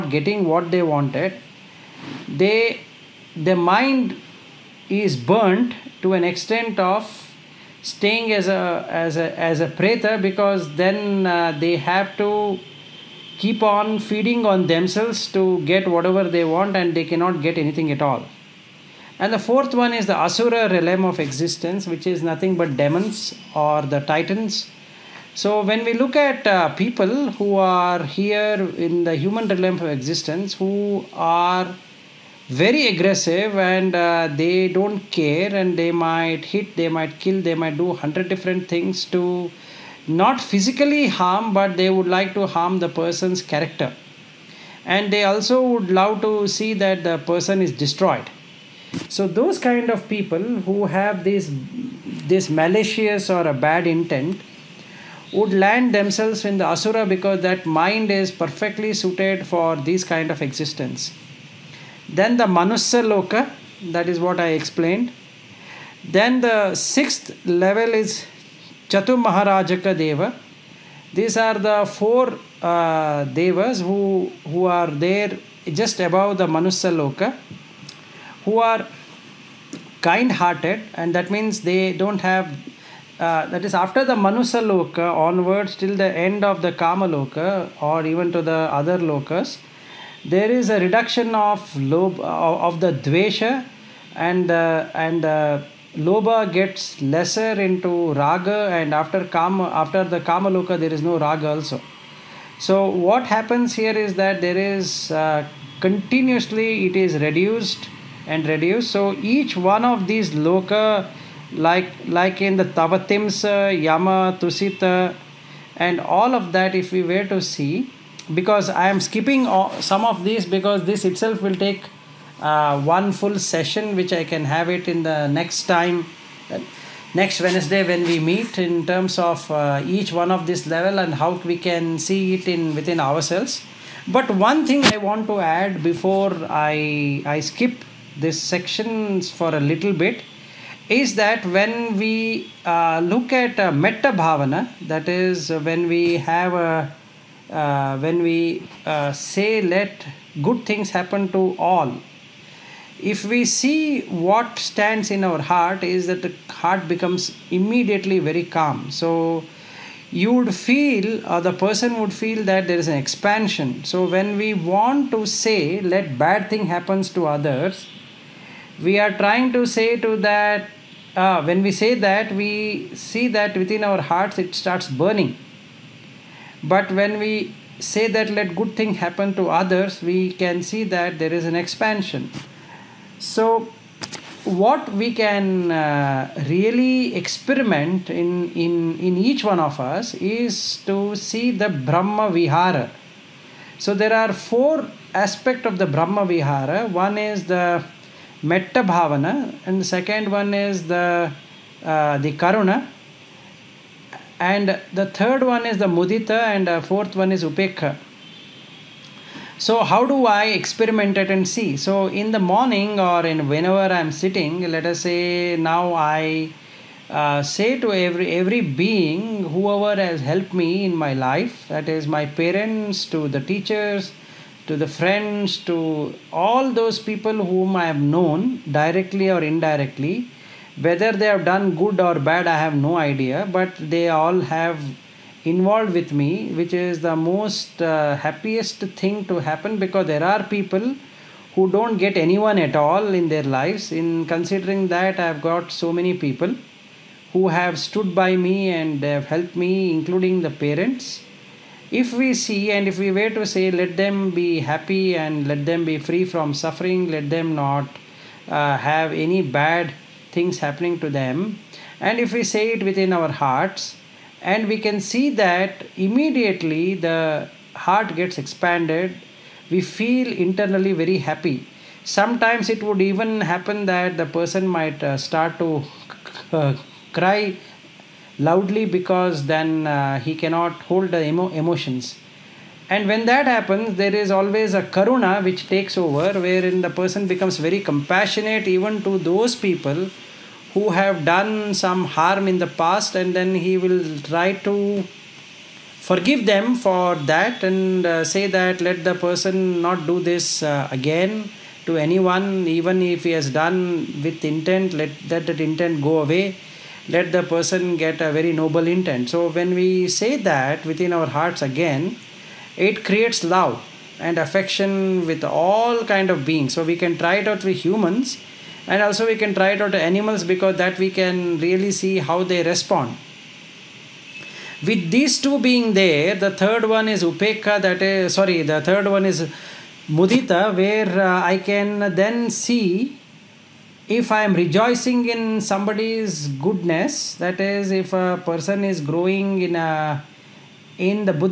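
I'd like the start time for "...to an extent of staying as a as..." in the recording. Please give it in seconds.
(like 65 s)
6 s.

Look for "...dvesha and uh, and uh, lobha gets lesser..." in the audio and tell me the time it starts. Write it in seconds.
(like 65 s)
93 s.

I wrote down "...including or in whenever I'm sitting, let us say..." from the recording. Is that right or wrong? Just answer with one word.
wrong.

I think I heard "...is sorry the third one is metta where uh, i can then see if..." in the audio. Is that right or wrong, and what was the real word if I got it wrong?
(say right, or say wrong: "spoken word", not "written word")
wrong: "mudita", not "metta".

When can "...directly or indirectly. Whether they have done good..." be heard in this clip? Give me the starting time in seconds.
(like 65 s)
228 s.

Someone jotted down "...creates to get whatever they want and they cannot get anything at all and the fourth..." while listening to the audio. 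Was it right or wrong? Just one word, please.
wrong.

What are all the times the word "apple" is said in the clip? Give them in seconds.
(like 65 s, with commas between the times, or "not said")
not said.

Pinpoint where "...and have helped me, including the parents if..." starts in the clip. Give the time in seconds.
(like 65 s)
248 s.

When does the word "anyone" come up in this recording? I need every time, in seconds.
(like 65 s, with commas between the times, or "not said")
242 s, 301 s.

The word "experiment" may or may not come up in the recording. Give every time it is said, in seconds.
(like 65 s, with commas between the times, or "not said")
187 s, 210 s.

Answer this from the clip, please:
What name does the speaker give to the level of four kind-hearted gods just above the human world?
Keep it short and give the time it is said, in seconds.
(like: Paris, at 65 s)
Chatur Maharajaka deva, at 68 s.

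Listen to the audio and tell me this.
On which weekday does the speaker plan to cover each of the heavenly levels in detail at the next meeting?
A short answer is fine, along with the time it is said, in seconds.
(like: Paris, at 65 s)
Wednesday, at 127 s.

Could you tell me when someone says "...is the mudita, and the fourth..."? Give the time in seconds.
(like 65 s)
205 s.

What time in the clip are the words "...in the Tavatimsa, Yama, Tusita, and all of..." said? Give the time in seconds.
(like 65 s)
112 s.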